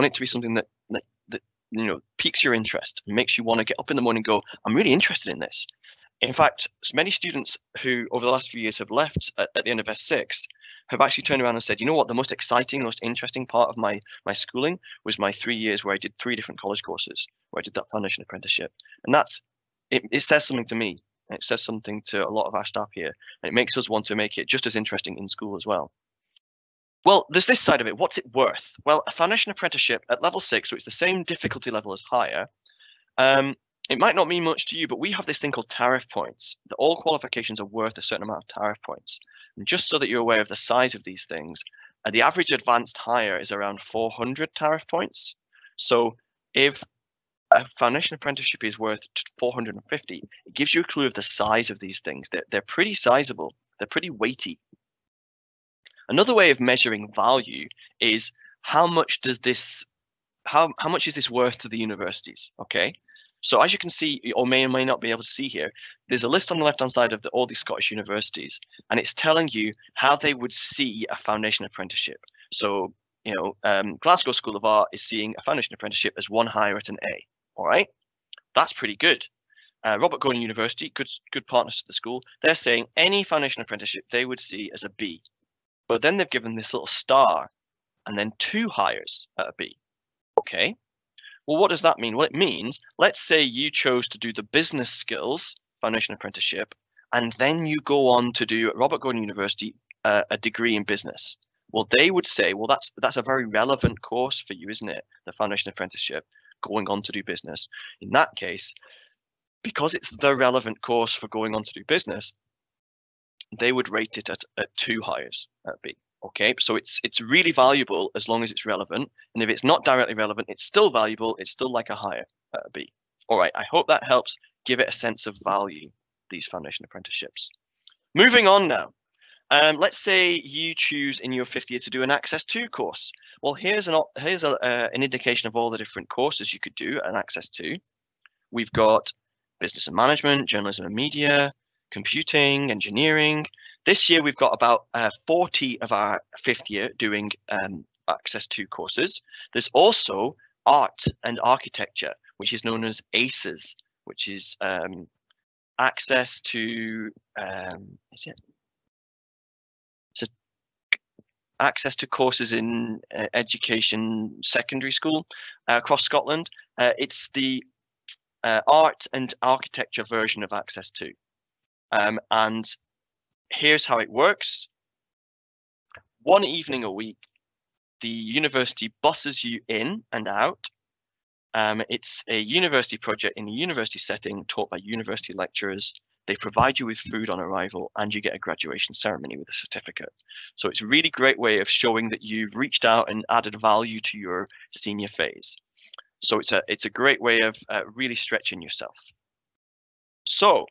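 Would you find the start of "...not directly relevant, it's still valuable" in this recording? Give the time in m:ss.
1:59.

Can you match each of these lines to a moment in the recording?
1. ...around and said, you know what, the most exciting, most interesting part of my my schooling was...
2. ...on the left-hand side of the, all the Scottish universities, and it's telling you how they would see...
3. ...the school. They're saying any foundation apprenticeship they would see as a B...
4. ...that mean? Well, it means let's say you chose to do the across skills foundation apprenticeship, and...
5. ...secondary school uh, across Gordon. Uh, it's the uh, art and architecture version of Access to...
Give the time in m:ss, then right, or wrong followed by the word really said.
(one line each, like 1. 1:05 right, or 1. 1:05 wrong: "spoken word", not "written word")
1. 0:11 right
2. 1:06 right
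3. 1:21 right
4. 1:31 wrong: "business", not "across"
5. 2:44 wrong: "Scotland", not "Gordon".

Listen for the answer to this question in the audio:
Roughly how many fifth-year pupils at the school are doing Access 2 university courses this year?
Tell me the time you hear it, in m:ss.
2:25.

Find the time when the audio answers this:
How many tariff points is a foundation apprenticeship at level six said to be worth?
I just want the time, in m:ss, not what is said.
0:49.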